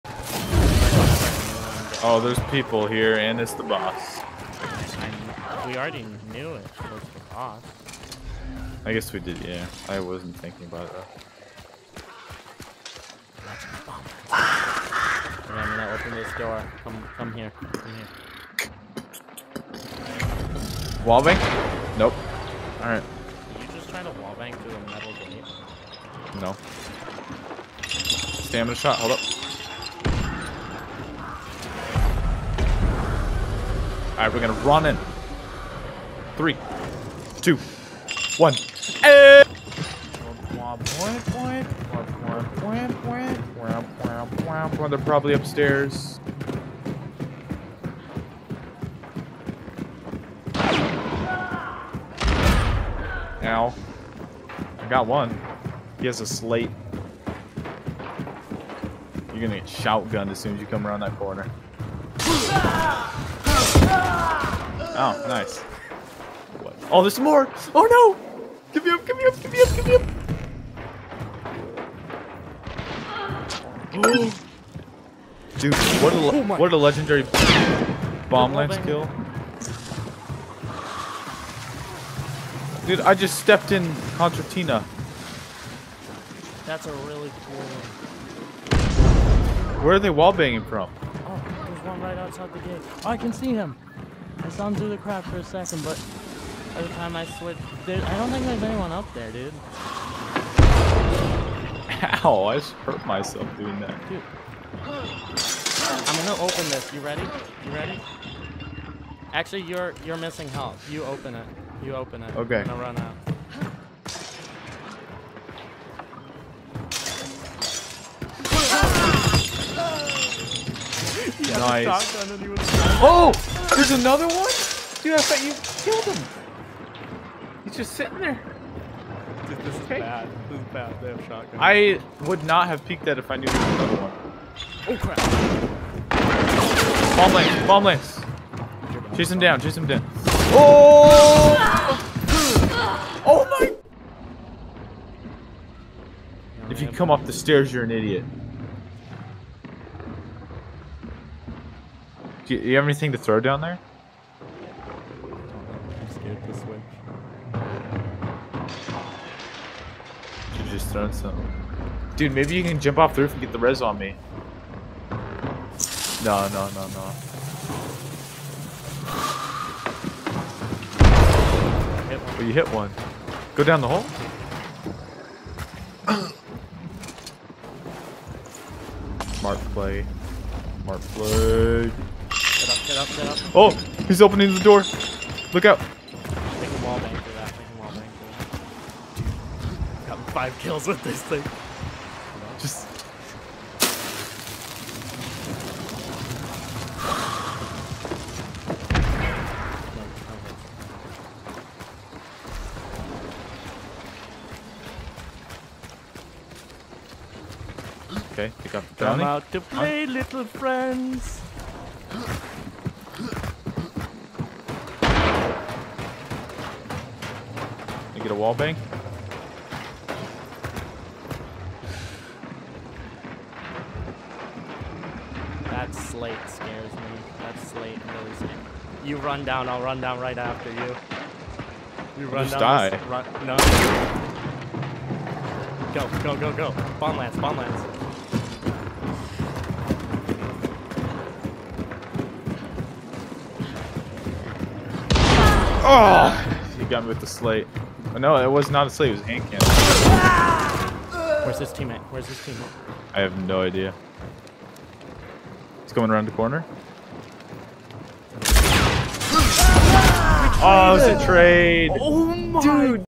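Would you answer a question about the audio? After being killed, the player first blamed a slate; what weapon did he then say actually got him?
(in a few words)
Hand cannon.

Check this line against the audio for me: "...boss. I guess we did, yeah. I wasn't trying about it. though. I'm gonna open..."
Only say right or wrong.
wrong.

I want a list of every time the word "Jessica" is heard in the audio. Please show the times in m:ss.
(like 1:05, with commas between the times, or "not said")
not said.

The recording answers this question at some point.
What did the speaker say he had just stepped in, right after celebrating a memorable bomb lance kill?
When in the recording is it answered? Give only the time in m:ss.
1:24.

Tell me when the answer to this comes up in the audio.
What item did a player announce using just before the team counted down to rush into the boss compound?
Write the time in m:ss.
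0:27.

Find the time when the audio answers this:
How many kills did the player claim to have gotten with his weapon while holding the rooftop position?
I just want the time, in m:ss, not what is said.
3:10.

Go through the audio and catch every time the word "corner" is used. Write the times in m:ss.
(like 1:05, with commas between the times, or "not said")
1:01, 4:16.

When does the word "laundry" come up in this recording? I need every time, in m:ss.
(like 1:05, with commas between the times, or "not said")
not said.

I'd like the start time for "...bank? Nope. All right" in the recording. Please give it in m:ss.
0:21.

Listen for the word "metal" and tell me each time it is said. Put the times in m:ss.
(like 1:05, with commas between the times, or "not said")
0:24.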